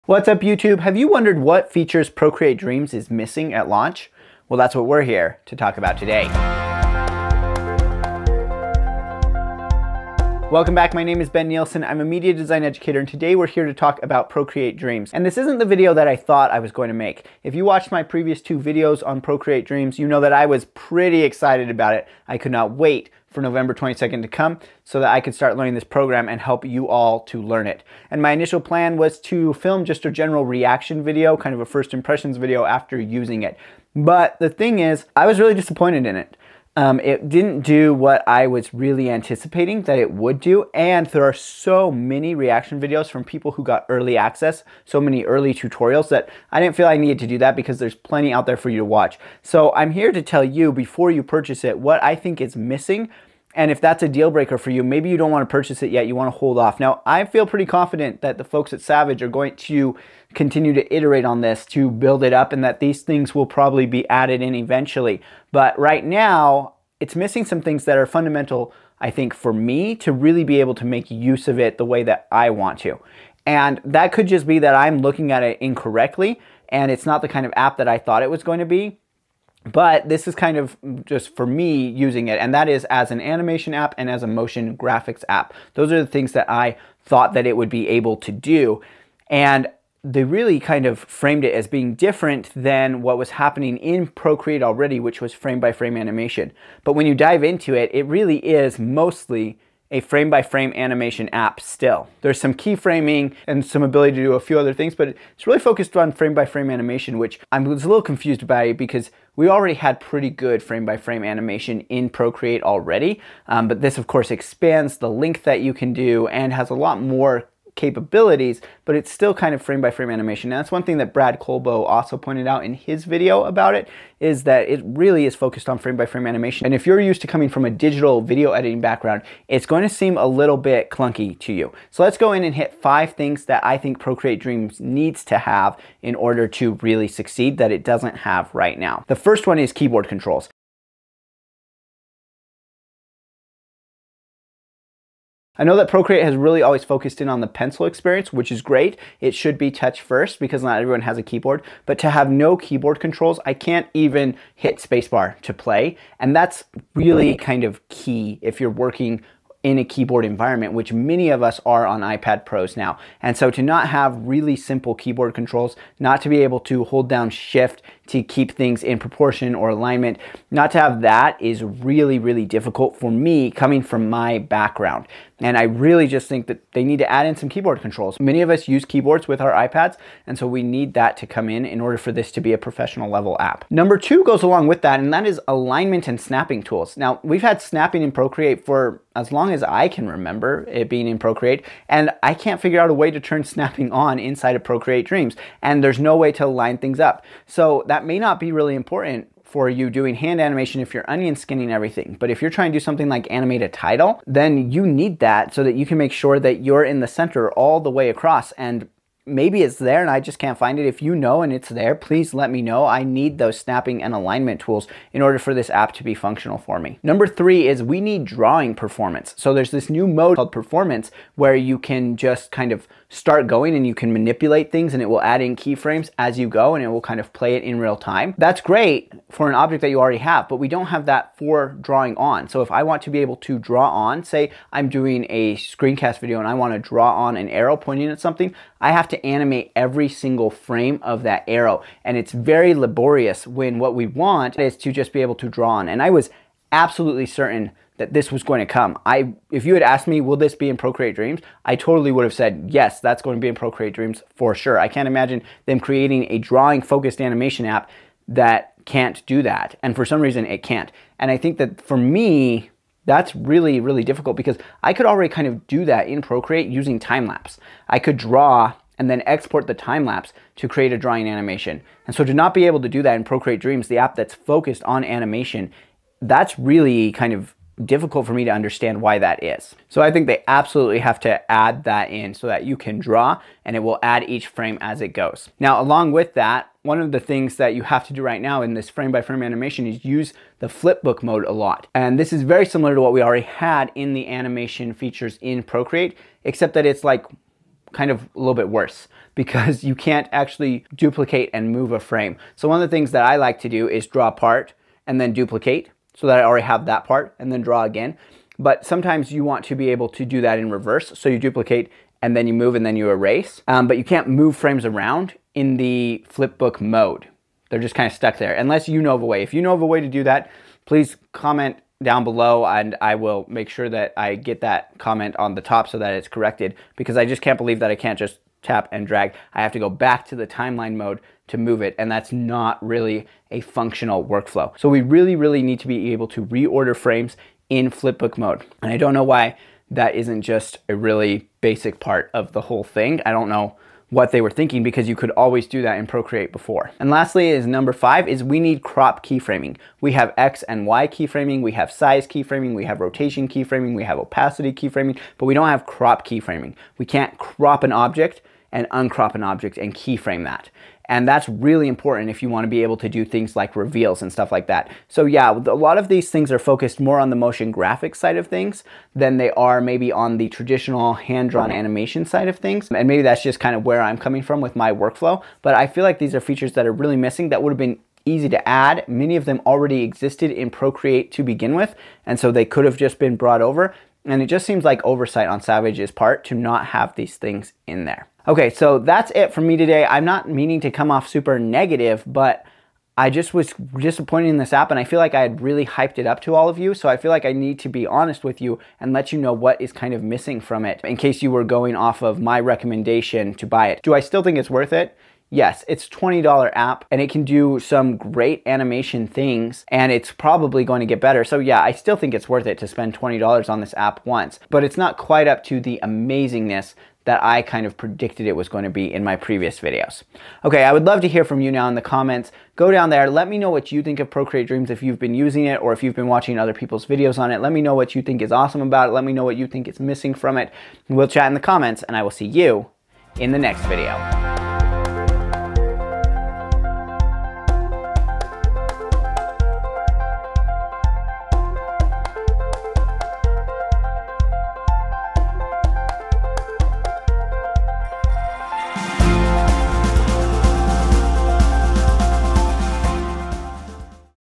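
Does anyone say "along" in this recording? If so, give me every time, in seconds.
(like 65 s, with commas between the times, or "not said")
184 s, 285 s.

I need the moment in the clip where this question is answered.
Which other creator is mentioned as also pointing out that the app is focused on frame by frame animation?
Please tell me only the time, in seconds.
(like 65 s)
121 s.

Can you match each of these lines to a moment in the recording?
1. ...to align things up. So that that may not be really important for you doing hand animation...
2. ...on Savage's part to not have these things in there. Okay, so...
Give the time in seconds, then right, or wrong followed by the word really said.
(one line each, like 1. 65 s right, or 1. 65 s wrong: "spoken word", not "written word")
1. 196 s right
2. 385 s right.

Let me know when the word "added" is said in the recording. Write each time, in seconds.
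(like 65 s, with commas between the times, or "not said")
64 s.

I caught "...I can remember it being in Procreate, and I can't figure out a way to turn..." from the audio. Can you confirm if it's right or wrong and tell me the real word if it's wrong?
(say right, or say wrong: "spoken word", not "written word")
right.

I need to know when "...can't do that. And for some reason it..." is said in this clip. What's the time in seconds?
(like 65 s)
258 s.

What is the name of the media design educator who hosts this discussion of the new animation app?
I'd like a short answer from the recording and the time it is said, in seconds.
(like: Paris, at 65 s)
Ben Nielsen, at 11 s.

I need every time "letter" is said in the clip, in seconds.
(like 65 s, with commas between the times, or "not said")
not said.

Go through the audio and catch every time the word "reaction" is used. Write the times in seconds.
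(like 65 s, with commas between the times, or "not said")
30 s, 42 s.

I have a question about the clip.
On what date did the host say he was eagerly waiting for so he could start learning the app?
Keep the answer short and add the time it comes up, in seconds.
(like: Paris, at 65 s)
November 22nd, at 23 s.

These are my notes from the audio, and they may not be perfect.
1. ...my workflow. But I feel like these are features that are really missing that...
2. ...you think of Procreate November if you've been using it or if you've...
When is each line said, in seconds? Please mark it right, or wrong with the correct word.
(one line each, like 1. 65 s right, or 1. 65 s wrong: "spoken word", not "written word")
1. 374 s right
2. 423 s wrong: "Dreams", not "November".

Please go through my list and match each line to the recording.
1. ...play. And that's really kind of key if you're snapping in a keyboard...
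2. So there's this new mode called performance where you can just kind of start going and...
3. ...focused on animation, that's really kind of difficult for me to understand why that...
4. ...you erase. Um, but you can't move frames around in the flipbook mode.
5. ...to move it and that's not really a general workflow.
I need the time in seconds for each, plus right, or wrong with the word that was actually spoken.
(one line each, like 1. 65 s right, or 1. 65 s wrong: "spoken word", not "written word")
1. 155 s wrong: "working", not "snapping"
2. 219 s right
3. 274 s right
4. 312 s right
5. 331 s wrong: "functional", not "general".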